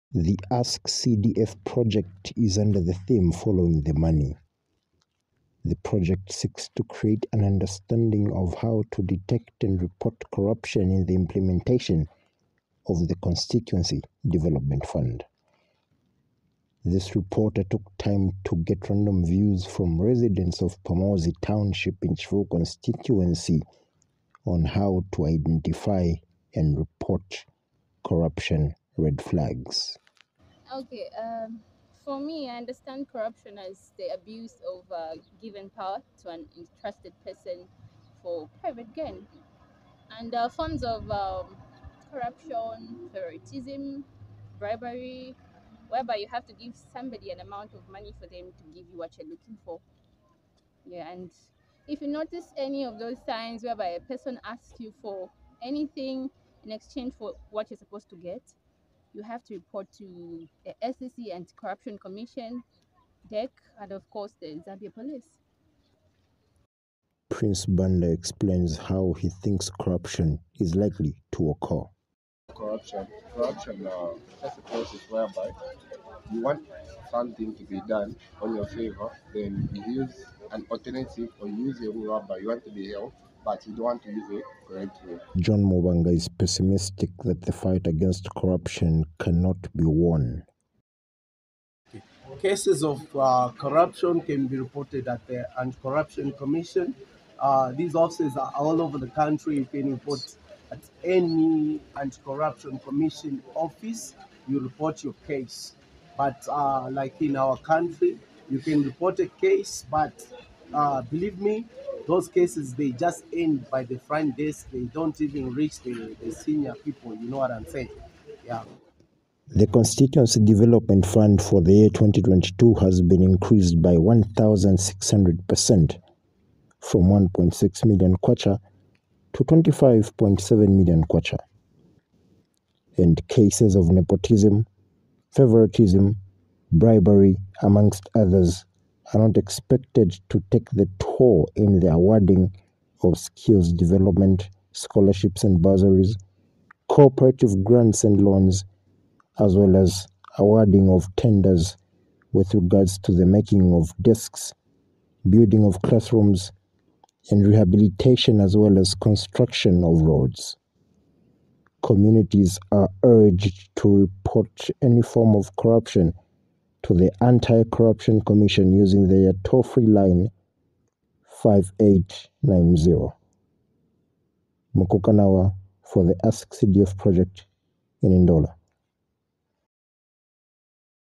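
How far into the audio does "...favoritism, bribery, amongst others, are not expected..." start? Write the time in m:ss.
2:15.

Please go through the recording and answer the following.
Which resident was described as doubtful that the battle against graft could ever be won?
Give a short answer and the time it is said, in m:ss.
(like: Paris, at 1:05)
John Mubanga, at 1:25.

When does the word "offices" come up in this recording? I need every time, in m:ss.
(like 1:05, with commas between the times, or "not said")
1:37, 1:43.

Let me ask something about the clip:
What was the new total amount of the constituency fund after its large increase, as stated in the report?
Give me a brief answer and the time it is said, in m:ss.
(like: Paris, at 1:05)
25.7 million kwacha, at 2:09.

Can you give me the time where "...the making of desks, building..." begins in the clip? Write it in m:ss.
2:33.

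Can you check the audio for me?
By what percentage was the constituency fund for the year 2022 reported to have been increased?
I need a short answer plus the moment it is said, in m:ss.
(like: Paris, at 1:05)
1,600%, at 2:03.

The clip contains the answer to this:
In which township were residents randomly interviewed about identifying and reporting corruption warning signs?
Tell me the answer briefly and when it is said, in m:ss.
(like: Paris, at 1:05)
Pamodzi, at 0:20.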